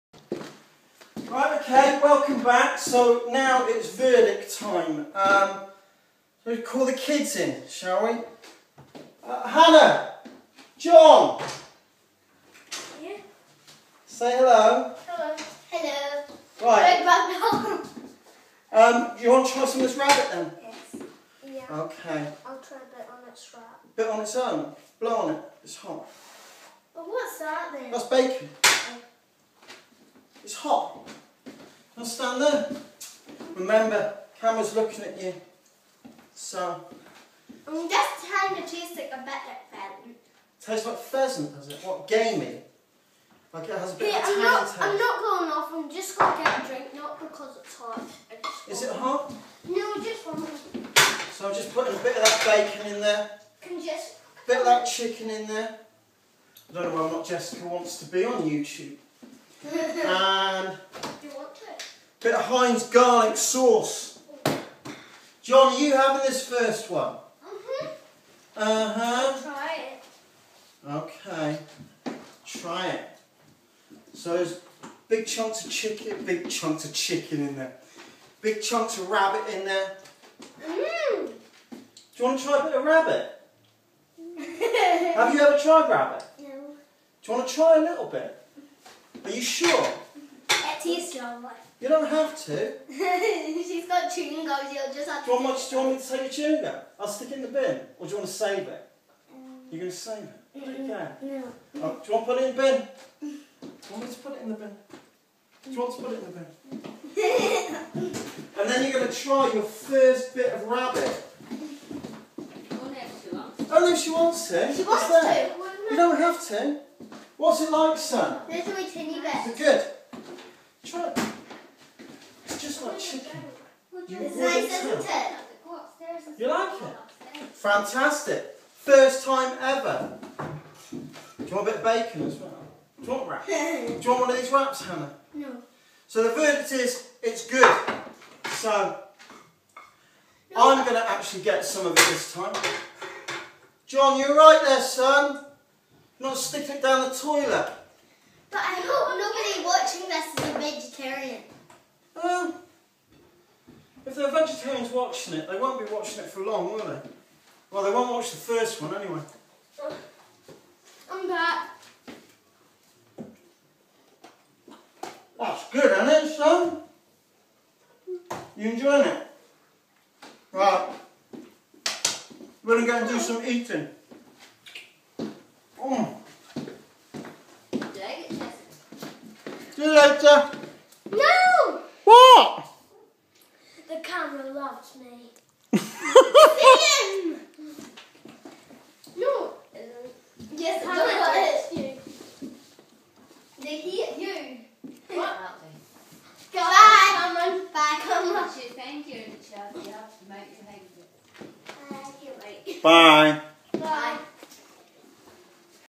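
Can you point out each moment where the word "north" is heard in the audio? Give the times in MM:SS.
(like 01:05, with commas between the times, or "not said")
not said.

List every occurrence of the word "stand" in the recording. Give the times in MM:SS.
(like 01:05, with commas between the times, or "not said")
00:32.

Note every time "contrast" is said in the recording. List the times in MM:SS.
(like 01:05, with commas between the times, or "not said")
not said.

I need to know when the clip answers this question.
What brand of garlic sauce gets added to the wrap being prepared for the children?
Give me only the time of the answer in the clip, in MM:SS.
01:02.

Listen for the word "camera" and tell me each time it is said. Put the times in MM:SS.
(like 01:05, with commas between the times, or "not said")
00:34, 03:04.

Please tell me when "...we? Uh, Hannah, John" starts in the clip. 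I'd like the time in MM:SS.
00:08.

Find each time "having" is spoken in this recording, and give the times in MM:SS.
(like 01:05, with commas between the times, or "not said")
01:05.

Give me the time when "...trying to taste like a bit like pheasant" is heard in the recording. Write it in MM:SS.
00:38.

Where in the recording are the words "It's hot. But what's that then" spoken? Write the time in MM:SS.
00:25.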